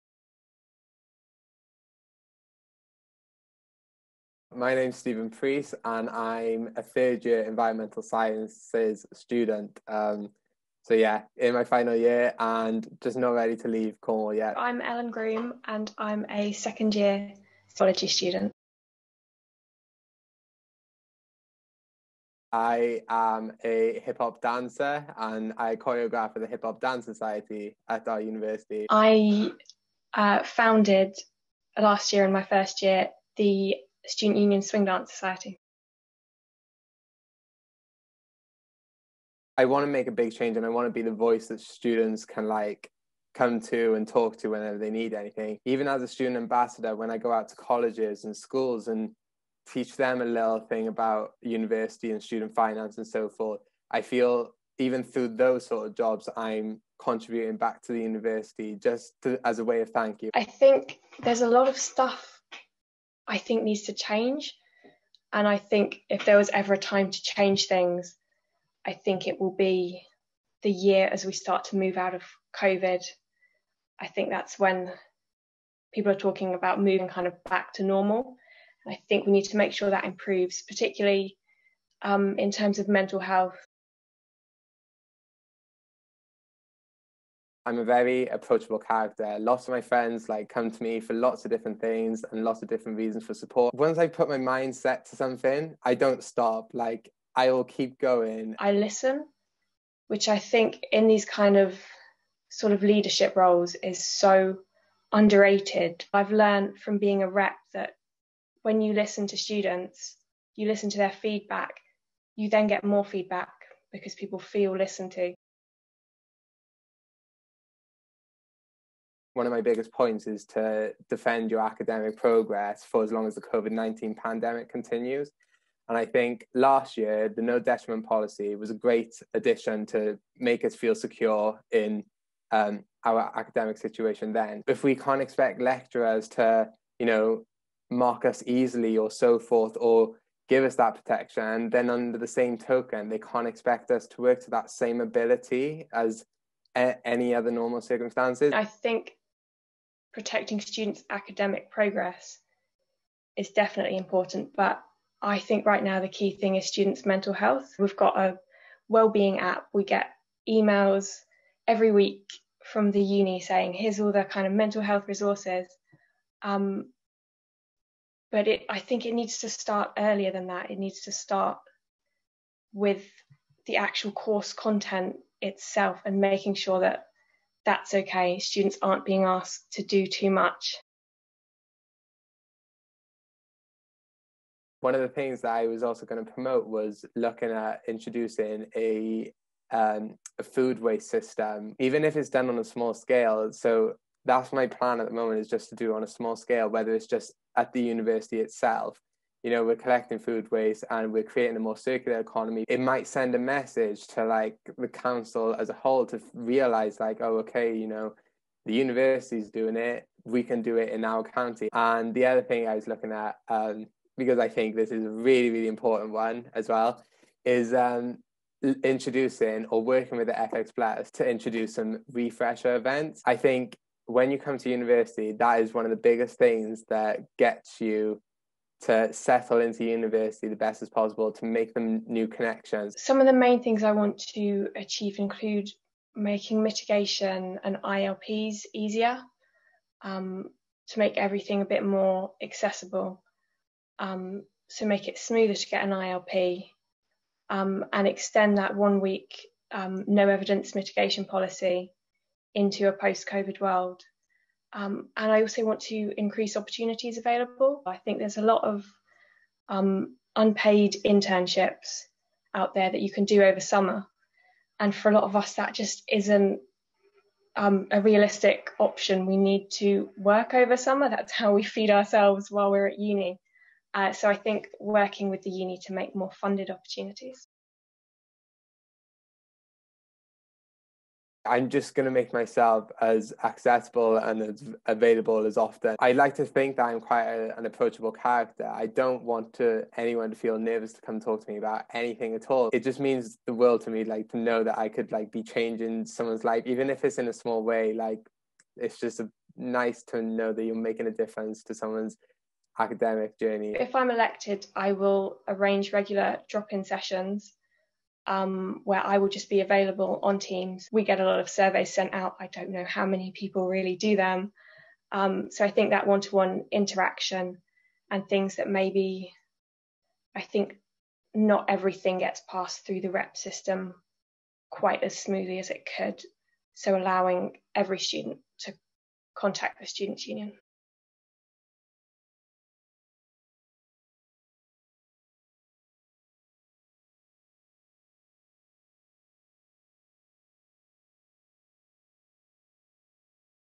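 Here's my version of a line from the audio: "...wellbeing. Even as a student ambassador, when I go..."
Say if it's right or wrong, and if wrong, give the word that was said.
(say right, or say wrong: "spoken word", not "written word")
wrong: "anything", not "wellbeing".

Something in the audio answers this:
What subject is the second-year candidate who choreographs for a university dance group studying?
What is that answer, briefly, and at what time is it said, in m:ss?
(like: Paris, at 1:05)
Zoology, at 0:17.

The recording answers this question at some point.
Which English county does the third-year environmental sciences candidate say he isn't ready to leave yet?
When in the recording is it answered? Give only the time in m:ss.
0:14.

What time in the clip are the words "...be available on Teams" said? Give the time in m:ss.
5:09.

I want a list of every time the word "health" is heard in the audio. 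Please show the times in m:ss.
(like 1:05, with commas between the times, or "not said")
1:23, 2:37, 2:44.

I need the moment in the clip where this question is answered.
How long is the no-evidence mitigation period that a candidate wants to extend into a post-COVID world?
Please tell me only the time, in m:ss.
4:08.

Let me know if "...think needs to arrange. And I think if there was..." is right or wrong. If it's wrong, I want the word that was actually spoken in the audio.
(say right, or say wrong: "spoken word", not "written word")
wrong: "change", not "arrange".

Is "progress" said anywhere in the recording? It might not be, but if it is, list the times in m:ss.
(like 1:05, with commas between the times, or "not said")
2:02, 2:31.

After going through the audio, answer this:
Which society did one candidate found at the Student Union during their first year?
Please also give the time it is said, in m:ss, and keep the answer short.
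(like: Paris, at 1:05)
Swing Dance Society, at 0:34.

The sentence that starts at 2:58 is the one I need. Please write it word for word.
Students aren't being asked to do too much.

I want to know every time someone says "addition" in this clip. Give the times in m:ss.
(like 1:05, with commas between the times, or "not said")
2:09.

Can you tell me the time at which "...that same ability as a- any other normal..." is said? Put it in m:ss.
2:24.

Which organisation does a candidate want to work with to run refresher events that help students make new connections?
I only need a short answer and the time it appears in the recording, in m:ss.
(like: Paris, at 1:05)
FX Plus, at 3:40.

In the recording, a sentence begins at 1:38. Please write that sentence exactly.
I listen, which I think in these kind of sort of leadership roles is so underrated.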